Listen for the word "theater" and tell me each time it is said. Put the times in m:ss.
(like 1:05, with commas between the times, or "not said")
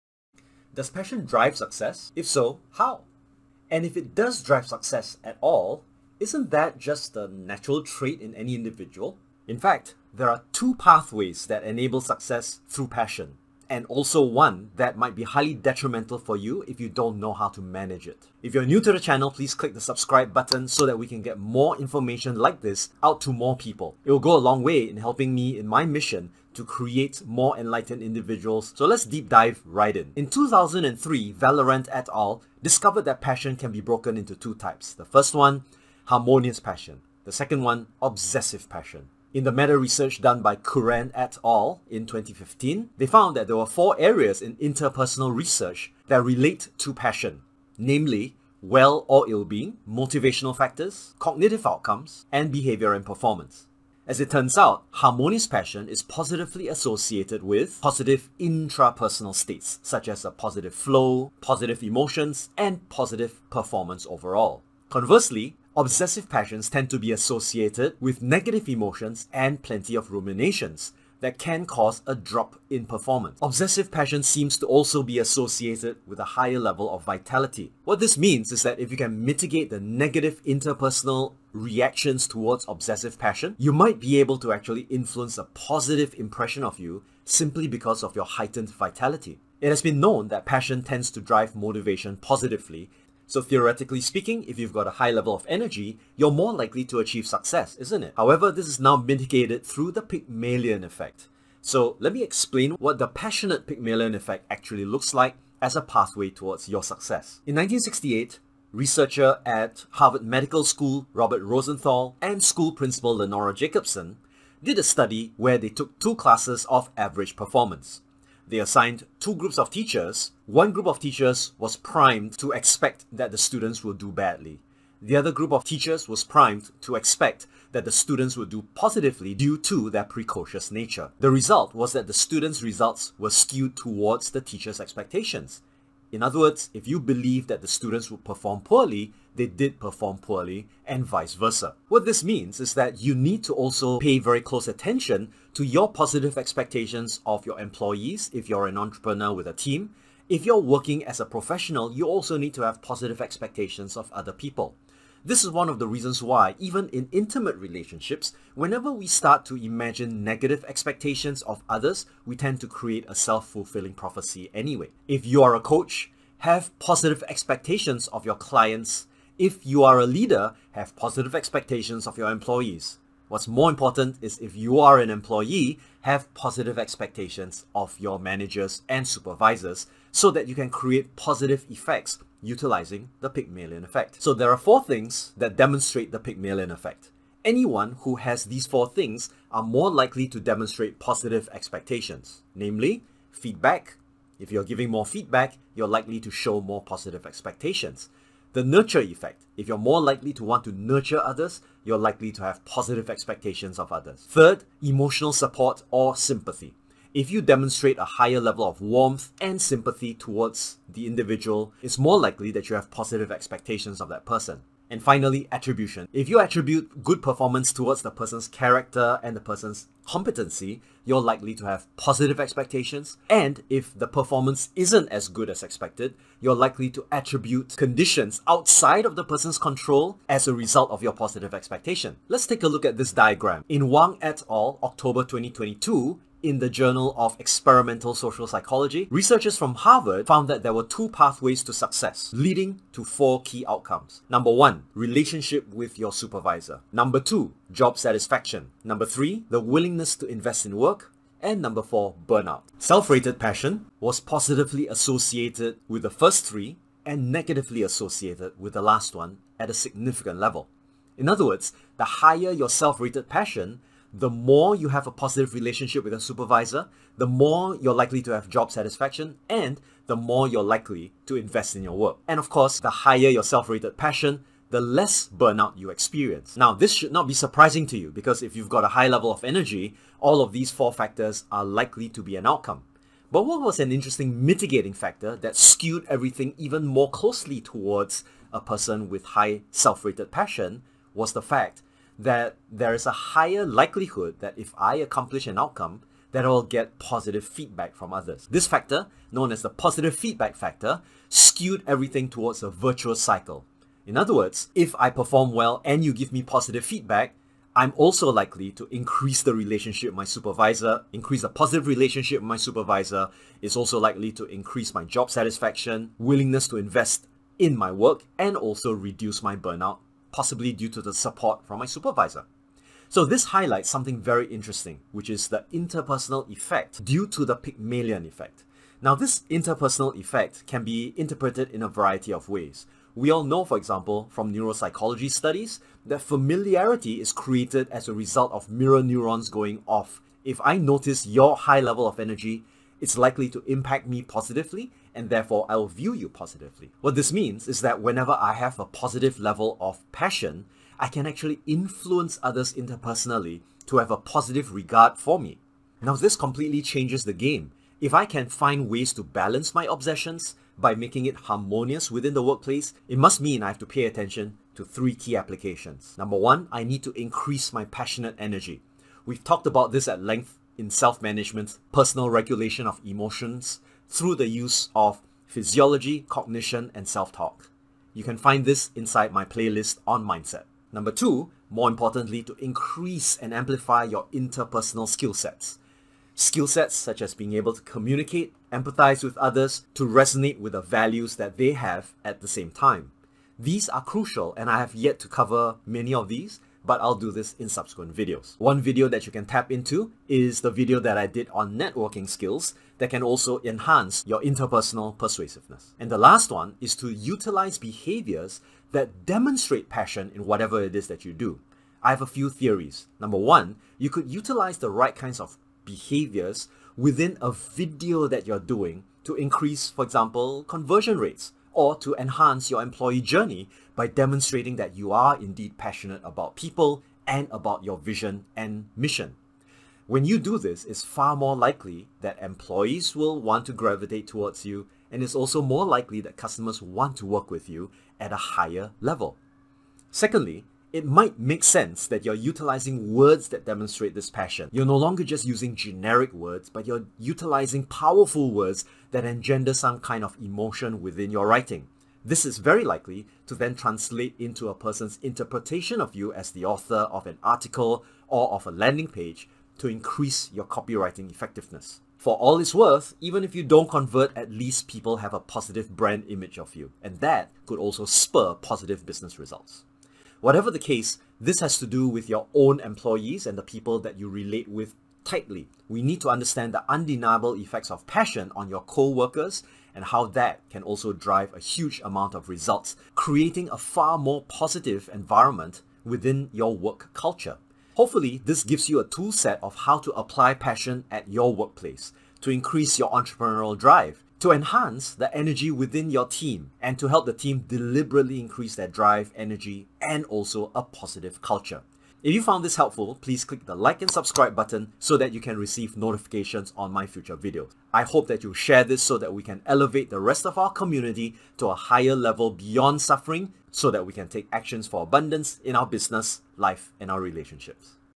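not said.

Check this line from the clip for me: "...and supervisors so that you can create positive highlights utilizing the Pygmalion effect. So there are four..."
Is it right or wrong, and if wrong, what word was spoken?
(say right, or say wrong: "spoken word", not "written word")
wrong: "effects", not "highlights".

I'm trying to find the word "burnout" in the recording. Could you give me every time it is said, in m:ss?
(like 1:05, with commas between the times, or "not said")
4:12, 4:35, 5:19.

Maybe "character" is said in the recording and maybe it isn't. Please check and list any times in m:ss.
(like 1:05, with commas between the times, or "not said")
3:38.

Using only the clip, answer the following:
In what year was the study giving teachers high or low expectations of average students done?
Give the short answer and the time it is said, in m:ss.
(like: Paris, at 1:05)
1968, at 1:47.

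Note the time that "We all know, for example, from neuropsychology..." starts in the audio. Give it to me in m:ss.
5:33.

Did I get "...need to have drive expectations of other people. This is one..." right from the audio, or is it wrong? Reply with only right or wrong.
wrong.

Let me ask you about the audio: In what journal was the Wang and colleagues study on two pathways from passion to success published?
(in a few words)
Journal of Experimental Social Psychology.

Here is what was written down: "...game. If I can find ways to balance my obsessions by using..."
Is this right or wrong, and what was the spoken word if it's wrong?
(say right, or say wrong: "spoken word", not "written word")
wrong: "making", not "using".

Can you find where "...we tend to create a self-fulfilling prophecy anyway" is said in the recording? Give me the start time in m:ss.
2:42.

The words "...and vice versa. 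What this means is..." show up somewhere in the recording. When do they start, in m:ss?
2:20.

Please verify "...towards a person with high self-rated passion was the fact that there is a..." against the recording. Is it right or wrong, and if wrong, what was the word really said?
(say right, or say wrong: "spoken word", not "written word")
right.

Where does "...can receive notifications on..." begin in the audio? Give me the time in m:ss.
8:25.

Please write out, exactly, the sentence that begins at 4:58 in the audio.
This factor, known as the positive feedback factor, skewed everything towards a virtuous cycle.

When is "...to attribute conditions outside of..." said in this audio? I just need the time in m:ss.
3:46.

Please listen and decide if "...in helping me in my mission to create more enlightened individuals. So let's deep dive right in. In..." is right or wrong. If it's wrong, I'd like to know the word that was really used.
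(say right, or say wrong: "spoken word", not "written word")
right.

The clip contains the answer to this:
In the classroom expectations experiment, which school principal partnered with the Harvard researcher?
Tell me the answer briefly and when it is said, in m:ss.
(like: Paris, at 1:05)
Lenora Jacobson, at 1:53.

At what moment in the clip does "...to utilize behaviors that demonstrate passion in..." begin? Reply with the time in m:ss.
6:46.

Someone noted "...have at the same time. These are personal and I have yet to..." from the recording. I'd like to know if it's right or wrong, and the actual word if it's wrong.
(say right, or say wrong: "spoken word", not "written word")
wrong: "crucial", not "personal".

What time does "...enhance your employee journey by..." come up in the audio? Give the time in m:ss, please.
7:02.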